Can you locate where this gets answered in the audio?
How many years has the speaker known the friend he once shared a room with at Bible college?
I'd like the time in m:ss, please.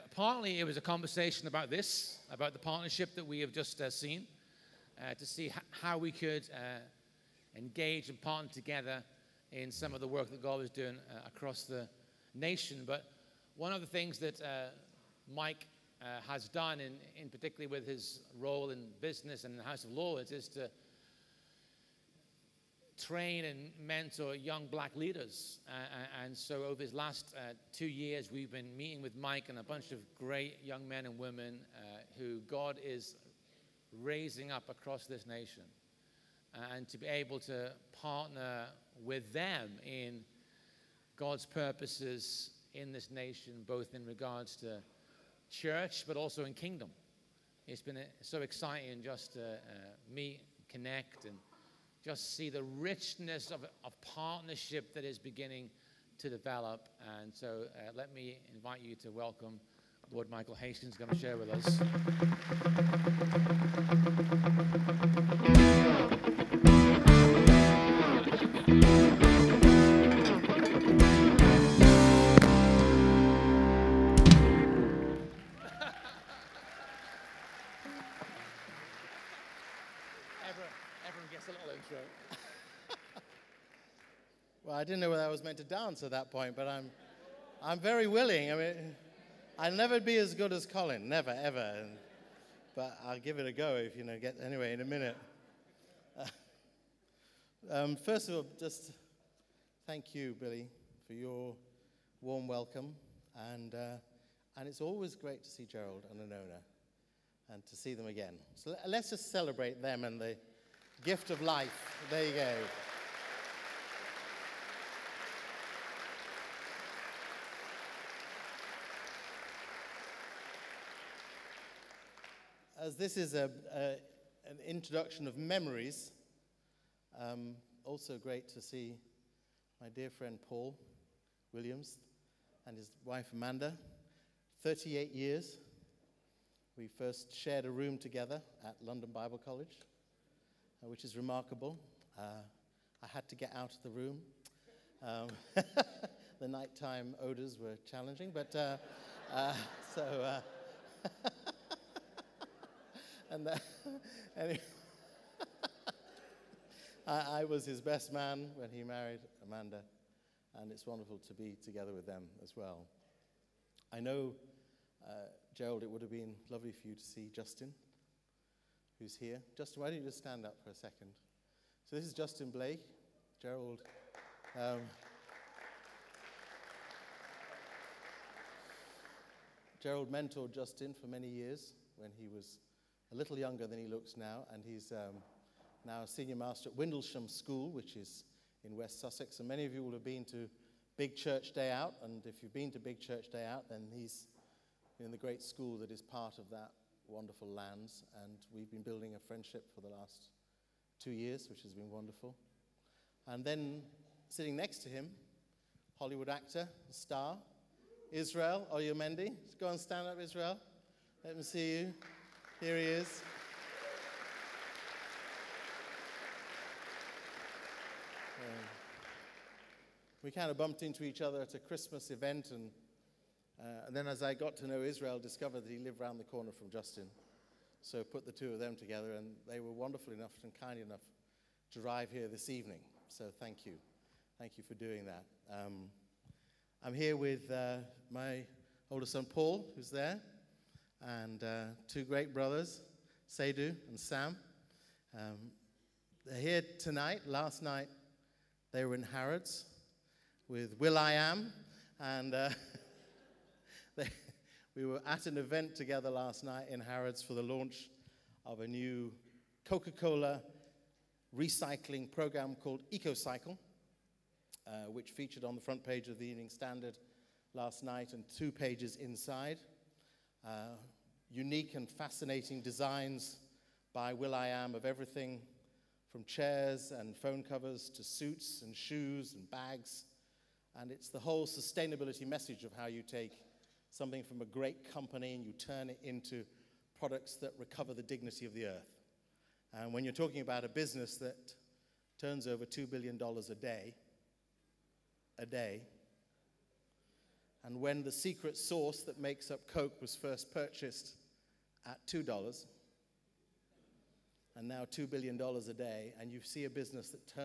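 2:14.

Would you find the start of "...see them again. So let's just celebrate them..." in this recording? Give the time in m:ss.
1:47.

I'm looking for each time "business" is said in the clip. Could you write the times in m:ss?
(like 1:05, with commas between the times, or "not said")
0:18, 4:50, 5:06.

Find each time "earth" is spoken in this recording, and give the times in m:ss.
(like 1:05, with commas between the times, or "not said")
4:48.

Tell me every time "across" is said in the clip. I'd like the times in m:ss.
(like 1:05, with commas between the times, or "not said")
0:11, 0:34.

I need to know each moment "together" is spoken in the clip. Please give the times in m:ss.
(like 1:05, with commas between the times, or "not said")
0:08, 2:17, 2:41, 3:48, 4:15.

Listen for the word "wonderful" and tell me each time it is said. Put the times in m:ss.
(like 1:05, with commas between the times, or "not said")
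2:40, 3:17, 3:21, 3:49.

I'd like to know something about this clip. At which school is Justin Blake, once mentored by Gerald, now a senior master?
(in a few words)
Windlesham School.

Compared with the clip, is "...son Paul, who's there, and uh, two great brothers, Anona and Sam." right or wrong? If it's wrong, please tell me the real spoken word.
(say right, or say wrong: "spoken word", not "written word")
wrong: "Seydou", not "Anona".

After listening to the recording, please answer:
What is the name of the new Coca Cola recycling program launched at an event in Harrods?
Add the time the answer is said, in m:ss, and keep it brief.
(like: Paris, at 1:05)
EKOCYCLE, at 4:22.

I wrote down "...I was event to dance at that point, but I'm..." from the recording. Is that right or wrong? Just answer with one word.
wrong.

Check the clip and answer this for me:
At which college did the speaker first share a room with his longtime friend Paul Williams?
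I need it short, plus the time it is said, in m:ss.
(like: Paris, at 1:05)
London Bible College, at 2:18.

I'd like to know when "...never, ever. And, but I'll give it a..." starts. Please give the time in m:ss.
1:31.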